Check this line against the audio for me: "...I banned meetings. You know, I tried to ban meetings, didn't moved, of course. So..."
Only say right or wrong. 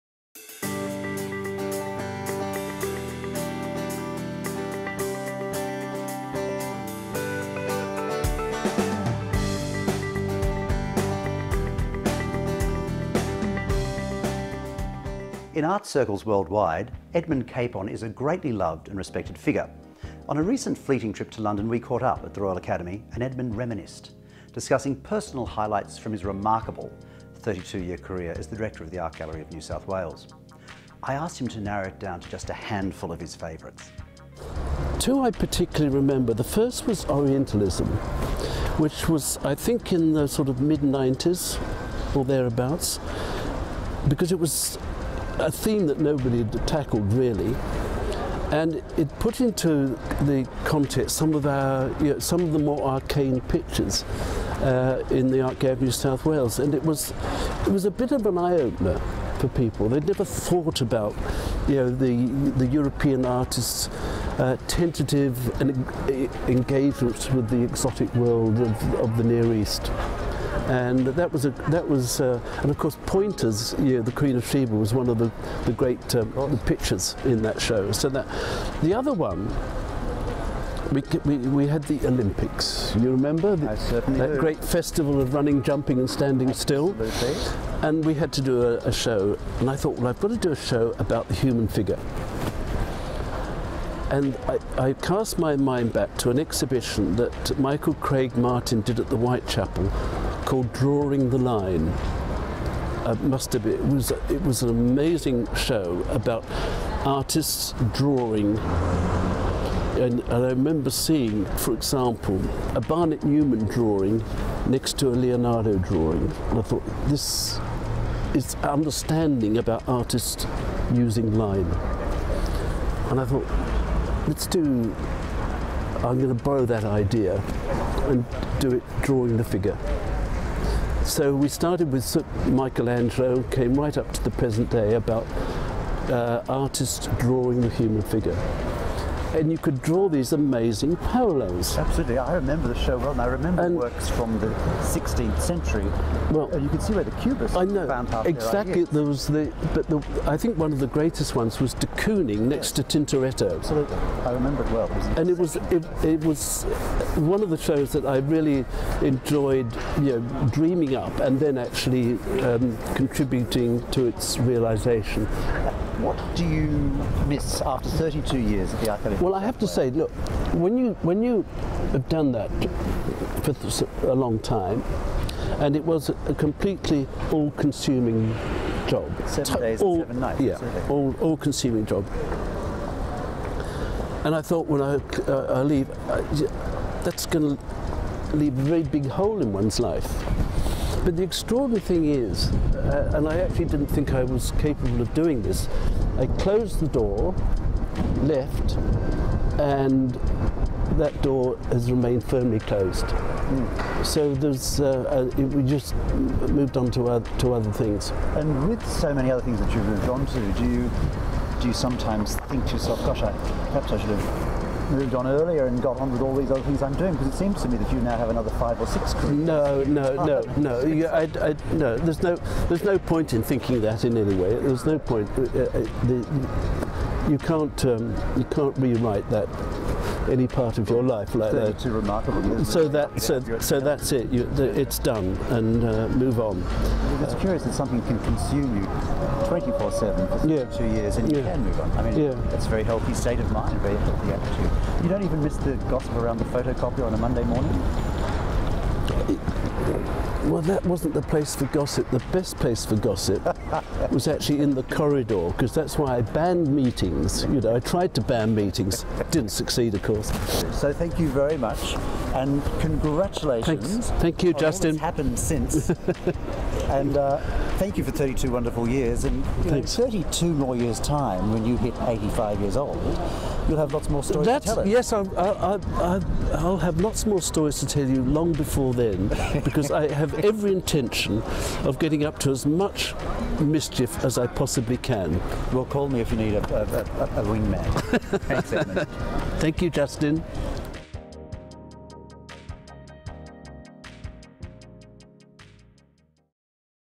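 wrong.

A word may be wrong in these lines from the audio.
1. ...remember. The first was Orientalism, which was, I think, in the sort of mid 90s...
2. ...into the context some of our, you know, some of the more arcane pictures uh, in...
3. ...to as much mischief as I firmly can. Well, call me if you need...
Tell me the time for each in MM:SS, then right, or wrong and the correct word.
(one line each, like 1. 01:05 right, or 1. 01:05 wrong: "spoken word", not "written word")
1. 00:35 right
2. 00:49 right
3. 04:42 wrong: "possibly", not "firmly".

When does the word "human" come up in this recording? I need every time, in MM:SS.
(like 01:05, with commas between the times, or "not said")
01:31, 02:17.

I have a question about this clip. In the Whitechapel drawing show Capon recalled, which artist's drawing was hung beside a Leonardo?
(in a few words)
Barnett Newman.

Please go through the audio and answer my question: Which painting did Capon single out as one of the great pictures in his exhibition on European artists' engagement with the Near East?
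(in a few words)
The Queen of Sheba.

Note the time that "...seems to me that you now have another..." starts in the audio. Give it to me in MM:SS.
03:37.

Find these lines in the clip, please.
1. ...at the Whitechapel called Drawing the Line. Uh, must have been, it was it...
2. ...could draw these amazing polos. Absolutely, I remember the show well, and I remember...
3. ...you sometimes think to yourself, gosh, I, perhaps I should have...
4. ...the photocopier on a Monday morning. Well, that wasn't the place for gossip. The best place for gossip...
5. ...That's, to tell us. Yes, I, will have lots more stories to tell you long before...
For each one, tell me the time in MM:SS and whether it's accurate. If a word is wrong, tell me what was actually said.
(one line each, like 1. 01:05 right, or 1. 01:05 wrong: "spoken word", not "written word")
1. 01:38 right
2. 02:19 right
3. 03:31 right
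4. 04:06 right
5. 04:34 right.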